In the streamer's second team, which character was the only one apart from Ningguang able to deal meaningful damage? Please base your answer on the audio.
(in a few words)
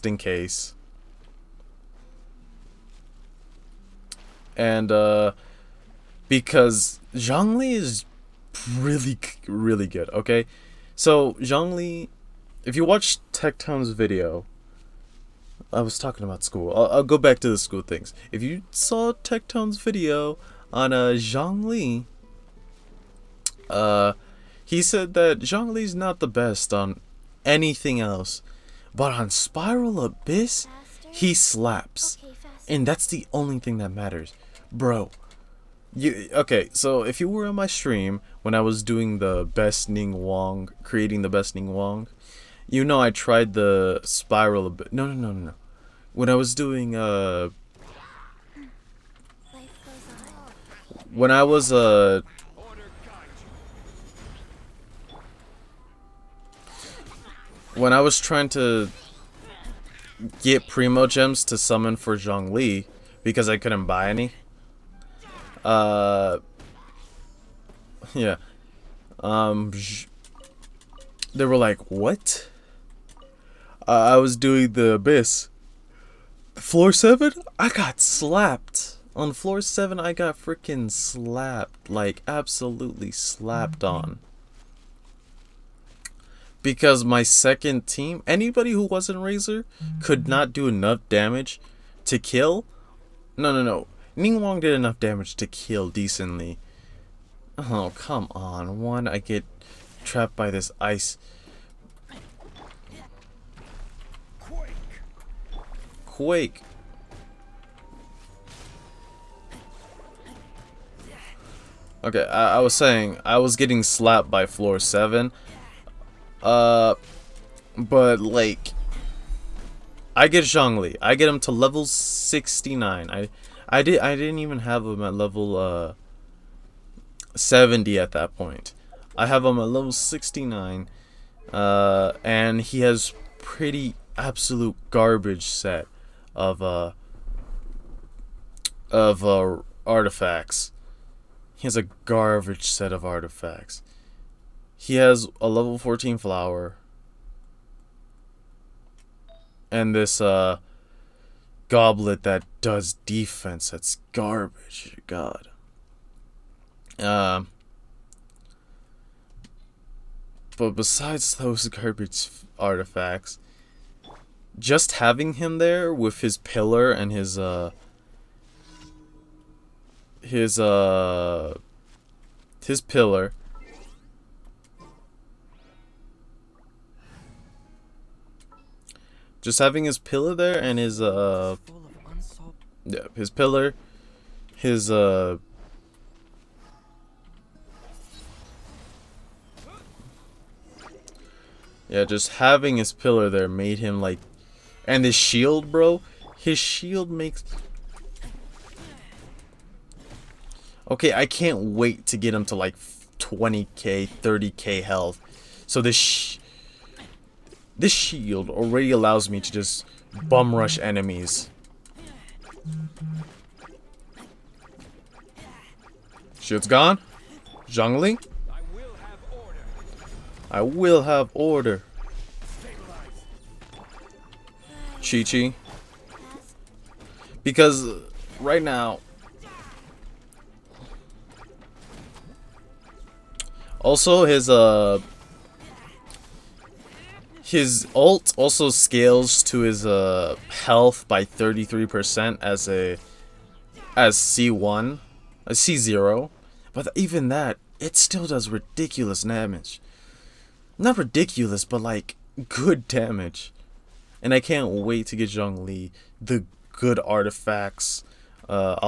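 Razor.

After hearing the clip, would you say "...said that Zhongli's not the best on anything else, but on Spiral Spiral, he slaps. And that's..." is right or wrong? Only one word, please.
wrong.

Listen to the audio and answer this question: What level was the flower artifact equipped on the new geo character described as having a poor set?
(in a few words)
14.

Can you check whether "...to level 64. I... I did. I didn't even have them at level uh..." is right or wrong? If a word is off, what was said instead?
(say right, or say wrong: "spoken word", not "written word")
wrong: "69", not "64".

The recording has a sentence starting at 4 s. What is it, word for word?
and uh, because Zhongli is really, really good.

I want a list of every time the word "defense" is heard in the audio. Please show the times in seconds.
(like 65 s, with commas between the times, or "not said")
153 s.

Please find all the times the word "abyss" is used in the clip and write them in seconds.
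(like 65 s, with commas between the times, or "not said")
30 s, 44 s, 74 s.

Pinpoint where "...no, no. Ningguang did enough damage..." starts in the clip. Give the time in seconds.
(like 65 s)
93 s.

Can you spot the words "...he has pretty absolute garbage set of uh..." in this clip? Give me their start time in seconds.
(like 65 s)
132 s.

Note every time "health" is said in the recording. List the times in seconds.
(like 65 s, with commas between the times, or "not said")
204 s, 240 s.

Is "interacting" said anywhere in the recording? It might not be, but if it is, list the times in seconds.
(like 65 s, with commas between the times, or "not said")
not said.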